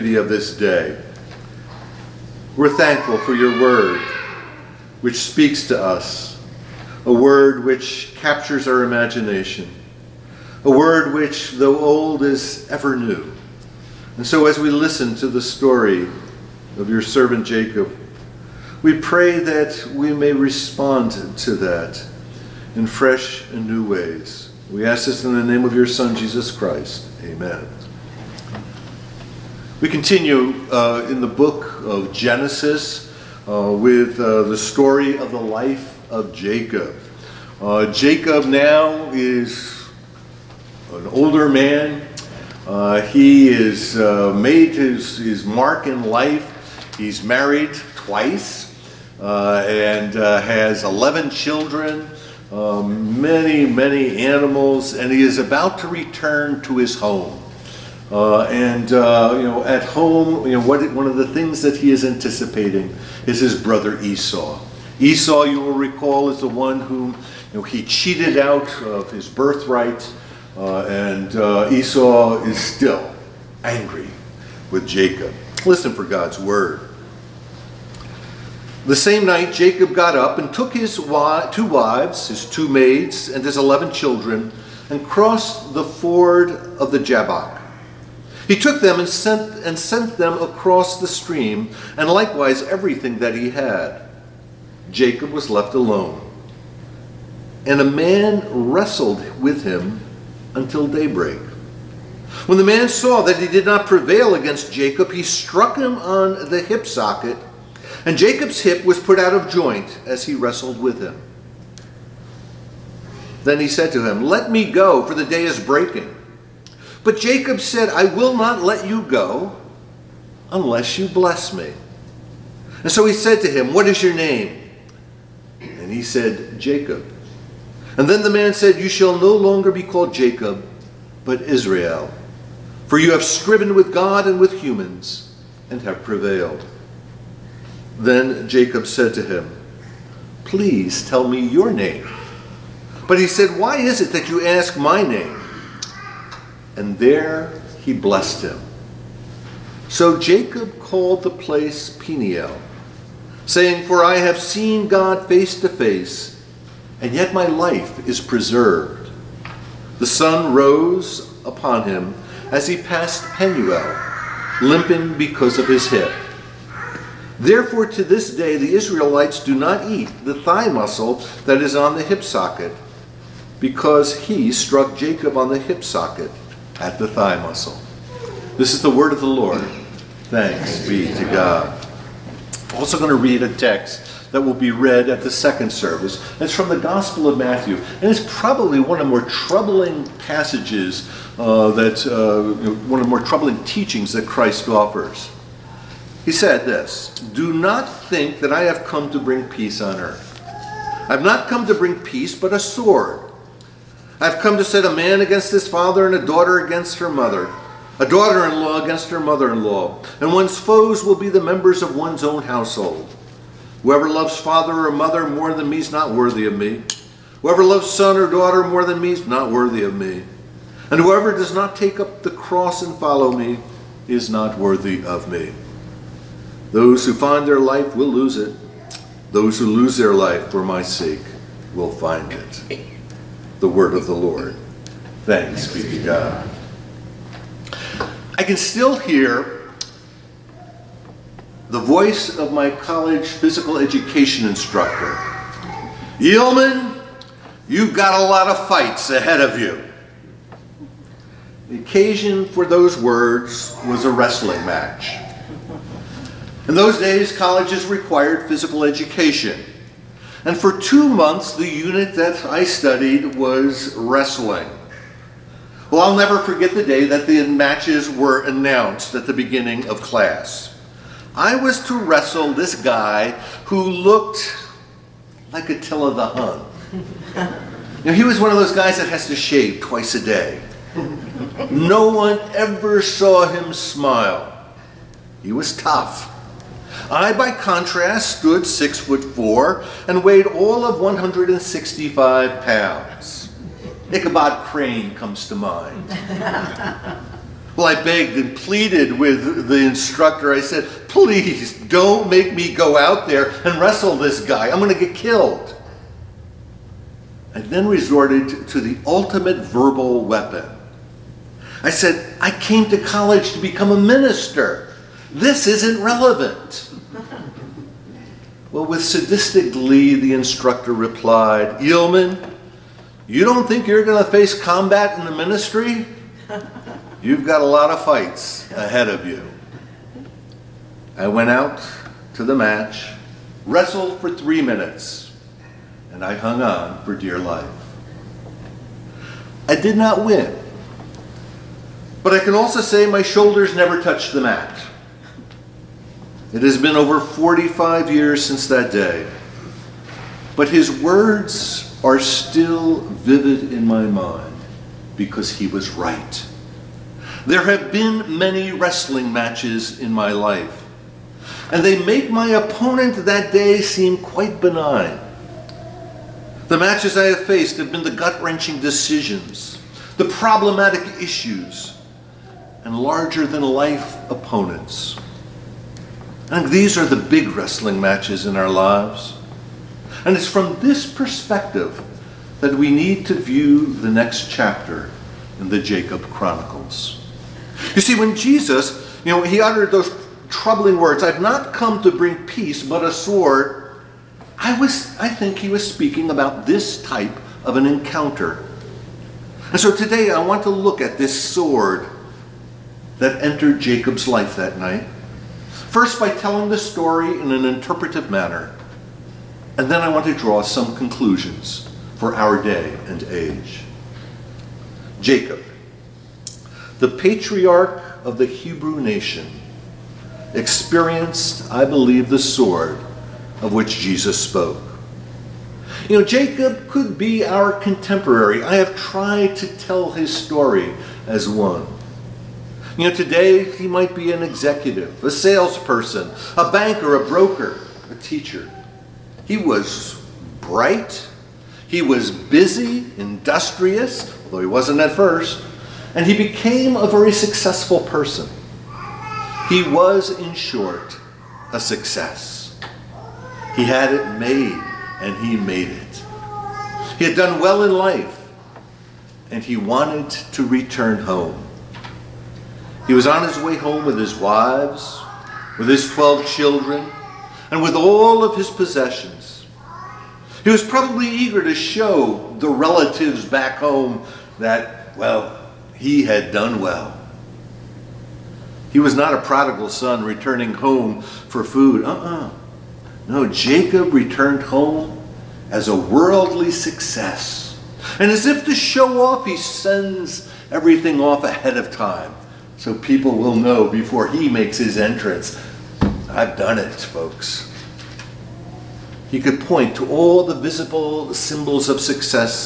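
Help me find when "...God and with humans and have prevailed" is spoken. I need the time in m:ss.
2:13.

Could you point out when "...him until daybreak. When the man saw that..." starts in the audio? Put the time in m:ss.
1:39.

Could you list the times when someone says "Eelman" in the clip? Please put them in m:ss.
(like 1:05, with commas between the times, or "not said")
4:06, 5:21.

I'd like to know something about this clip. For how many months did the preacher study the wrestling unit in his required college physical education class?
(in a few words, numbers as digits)
2.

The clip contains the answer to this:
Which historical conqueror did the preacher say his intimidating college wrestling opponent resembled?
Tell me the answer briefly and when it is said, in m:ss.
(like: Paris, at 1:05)
Attila the Hun, at 4:35.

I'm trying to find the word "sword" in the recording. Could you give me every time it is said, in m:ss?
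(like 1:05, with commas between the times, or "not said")
3:22, 6:33, 6:41, 7:02.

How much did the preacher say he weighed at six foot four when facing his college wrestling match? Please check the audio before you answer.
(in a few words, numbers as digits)
165 pounds.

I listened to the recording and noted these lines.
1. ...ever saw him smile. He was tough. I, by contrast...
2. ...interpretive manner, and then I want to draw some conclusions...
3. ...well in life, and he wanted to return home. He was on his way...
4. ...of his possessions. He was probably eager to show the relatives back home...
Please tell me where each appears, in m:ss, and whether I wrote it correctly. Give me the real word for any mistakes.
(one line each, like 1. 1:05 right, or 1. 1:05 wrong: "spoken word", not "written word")
1. 4:42 right
2. 6:47 right
3. 7:37 right
4. 7:48 right.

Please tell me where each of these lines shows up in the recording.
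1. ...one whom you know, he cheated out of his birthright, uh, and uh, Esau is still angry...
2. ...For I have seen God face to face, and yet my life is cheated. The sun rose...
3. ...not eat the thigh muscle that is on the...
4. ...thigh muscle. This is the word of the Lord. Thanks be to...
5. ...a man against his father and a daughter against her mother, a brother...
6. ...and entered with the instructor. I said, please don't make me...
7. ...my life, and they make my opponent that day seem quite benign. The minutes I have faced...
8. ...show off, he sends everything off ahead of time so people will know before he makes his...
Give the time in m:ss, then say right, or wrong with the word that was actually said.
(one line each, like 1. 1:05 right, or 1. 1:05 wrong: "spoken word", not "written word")
1. 1:06 right
2. 2:33 wrong: "preserved", not "cheated"
3. 2:49 right
4. 2:57 right
5. 3:24 wrong: "daughter", not "brother"
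6. 4:58 wrong: "pleaded", not "entered"
7. 6:00 wrong: "matches", not "minutes"
8. 8:08 right.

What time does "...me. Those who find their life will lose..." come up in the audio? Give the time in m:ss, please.
3:45.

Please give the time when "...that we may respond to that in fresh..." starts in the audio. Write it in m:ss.
0:19.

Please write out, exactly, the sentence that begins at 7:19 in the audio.
He was bright, he was busy, industrious, although he wasn't at first, and he became a very successful person.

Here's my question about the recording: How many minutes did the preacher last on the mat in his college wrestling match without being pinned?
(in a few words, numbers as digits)
3.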